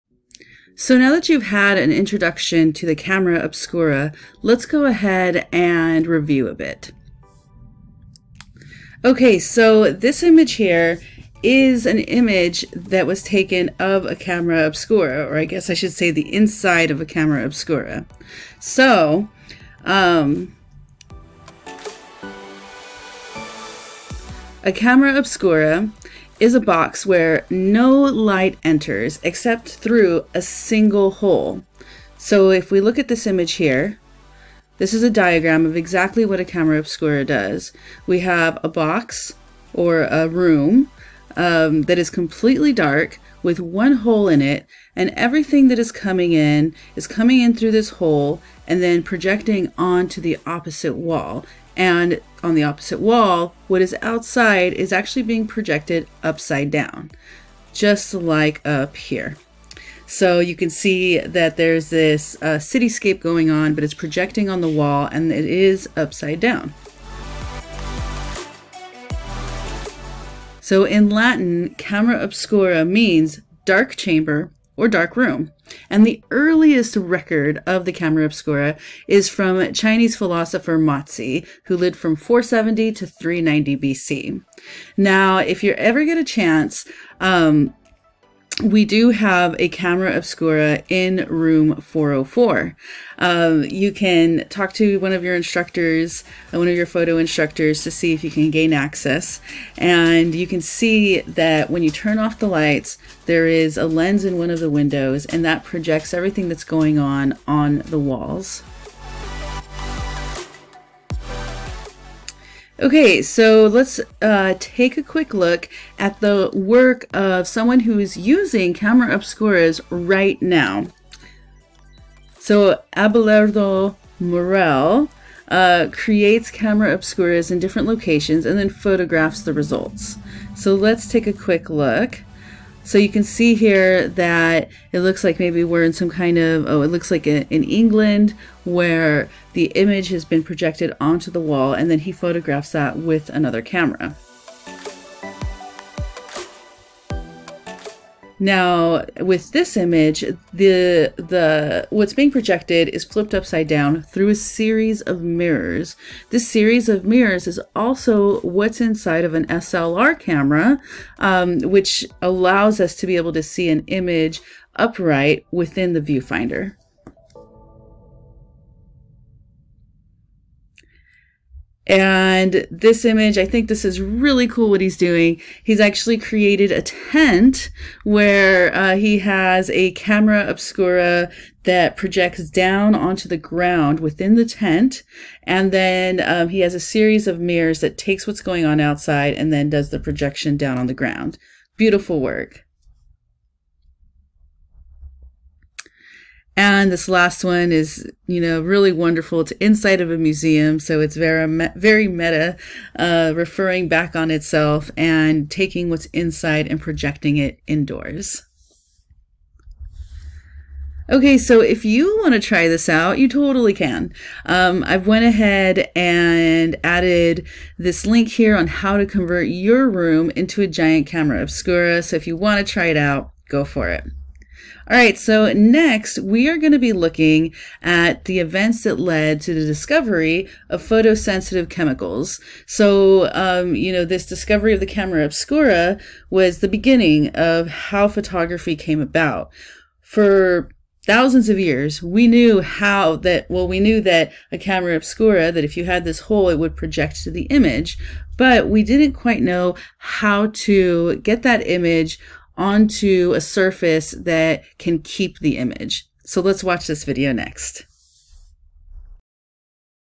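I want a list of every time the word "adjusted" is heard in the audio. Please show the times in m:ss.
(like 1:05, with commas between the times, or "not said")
not said.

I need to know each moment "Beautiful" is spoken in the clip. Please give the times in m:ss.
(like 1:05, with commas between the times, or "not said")
3:11.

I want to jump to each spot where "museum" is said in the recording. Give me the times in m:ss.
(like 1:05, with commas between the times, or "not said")
3:20.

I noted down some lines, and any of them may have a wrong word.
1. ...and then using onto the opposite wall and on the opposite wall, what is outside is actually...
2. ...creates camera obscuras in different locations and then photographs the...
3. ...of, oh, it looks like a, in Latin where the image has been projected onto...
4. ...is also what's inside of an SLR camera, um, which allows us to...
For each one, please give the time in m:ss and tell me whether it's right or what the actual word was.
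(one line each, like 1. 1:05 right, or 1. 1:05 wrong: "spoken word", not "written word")
1. 0:48 wrong: "projecting", not "using"
2. 2:05 right
3. 2:16 wrong: "England", not "Latin"
4. 2:37 right.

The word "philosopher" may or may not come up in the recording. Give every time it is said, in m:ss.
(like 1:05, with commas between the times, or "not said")
1:20.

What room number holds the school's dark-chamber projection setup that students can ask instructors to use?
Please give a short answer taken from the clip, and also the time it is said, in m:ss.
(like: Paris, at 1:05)
404, at 1:31.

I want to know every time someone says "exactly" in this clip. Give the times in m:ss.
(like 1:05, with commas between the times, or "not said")
0:35.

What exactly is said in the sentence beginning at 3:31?
Okay, so if you want to try this out, you totally can.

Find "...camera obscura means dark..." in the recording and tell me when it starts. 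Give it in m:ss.
1:11.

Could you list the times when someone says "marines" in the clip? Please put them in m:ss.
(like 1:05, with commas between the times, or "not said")
not said.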